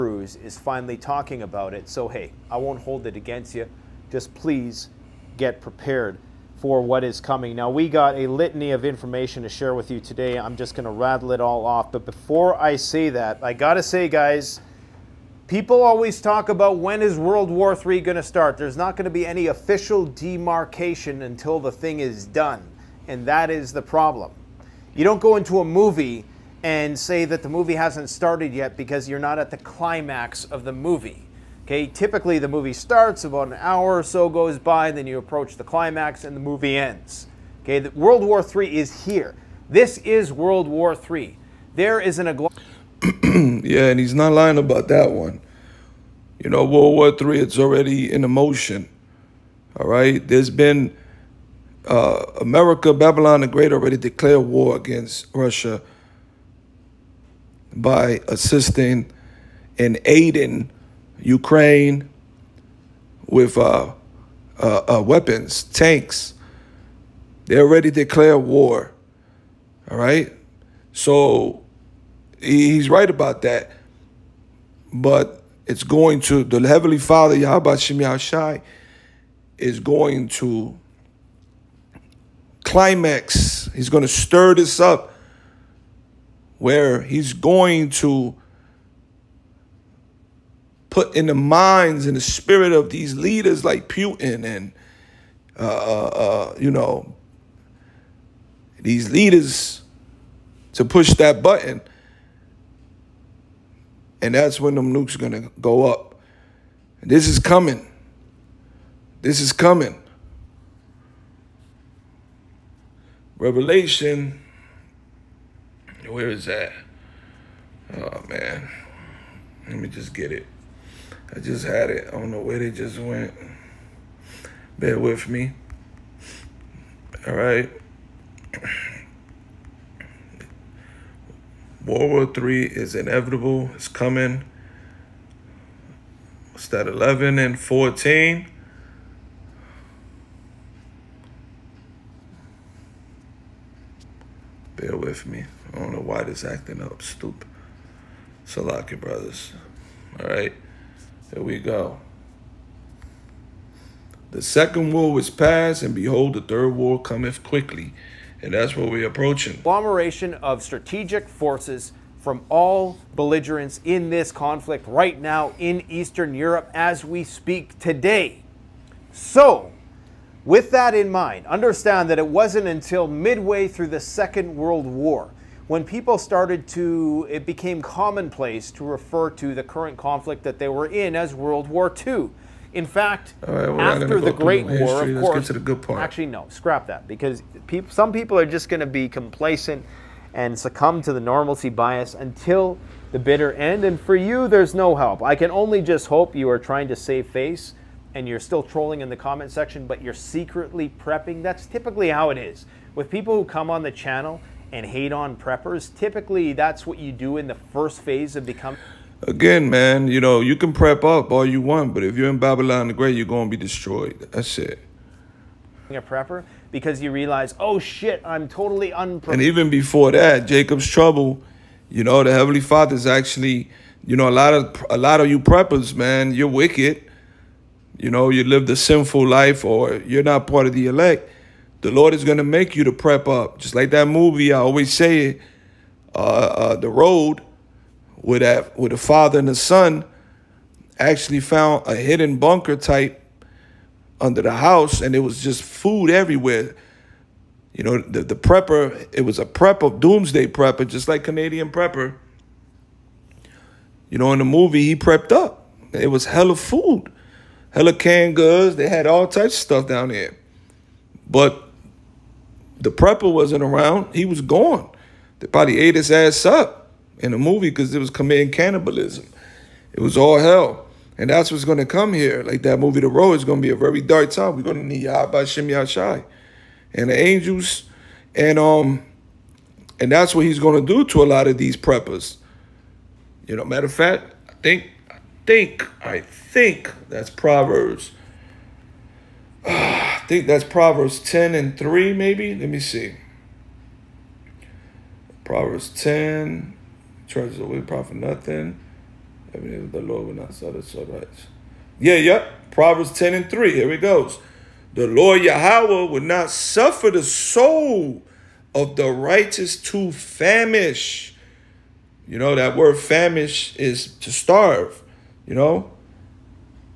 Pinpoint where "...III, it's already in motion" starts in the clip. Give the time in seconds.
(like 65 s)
47 s.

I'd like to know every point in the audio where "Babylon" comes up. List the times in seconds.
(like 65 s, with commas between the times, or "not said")
52 s, 212 s.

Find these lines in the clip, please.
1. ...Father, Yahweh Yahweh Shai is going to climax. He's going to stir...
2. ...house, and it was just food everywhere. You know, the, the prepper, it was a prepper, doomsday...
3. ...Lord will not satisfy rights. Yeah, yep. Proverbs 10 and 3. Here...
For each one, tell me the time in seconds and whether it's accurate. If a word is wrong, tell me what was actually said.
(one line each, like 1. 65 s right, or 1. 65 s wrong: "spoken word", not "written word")
1. 76 s wrong: "Shem", not "Yahweh"
2. 244 s right
3. 300 s right.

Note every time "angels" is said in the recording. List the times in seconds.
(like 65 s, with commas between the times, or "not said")
277 s.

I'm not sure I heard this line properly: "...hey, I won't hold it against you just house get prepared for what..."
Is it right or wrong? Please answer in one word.
wrong.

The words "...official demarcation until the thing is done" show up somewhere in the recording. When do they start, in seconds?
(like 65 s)
19 s.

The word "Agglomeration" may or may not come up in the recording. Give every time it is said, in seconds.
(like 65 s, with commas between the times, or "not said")
159 s.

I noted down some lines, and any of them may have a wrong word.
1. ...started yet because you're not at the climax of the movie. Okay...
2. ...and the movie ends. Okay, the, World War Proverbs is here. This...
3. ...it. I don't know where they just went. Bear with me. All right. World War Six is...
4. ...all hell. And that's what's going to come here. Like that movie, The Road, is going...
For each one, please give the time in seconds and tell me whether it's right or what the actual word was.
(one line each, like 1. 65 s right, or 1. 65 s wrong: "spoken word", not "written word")
1. 28 s right
2. 36 s wrong: "III", not "Proverbs"
3. 121 s wrong: "Three", not "Six"
4. 270 s right.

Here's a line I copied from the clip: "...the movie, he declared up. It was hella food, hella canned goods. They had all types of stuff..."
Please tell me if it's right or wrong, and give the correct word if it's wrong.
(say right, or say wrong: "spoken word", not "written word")
wrong: "prepped", not "declared".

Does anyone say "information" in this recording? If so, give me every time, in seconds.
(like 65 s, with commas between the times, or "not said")
8 s.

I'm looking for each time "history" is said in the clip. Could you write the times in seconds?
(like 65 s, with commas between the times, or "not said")
184 s.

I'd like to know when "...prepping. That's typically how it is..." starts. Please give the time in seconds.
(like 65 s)
200 s.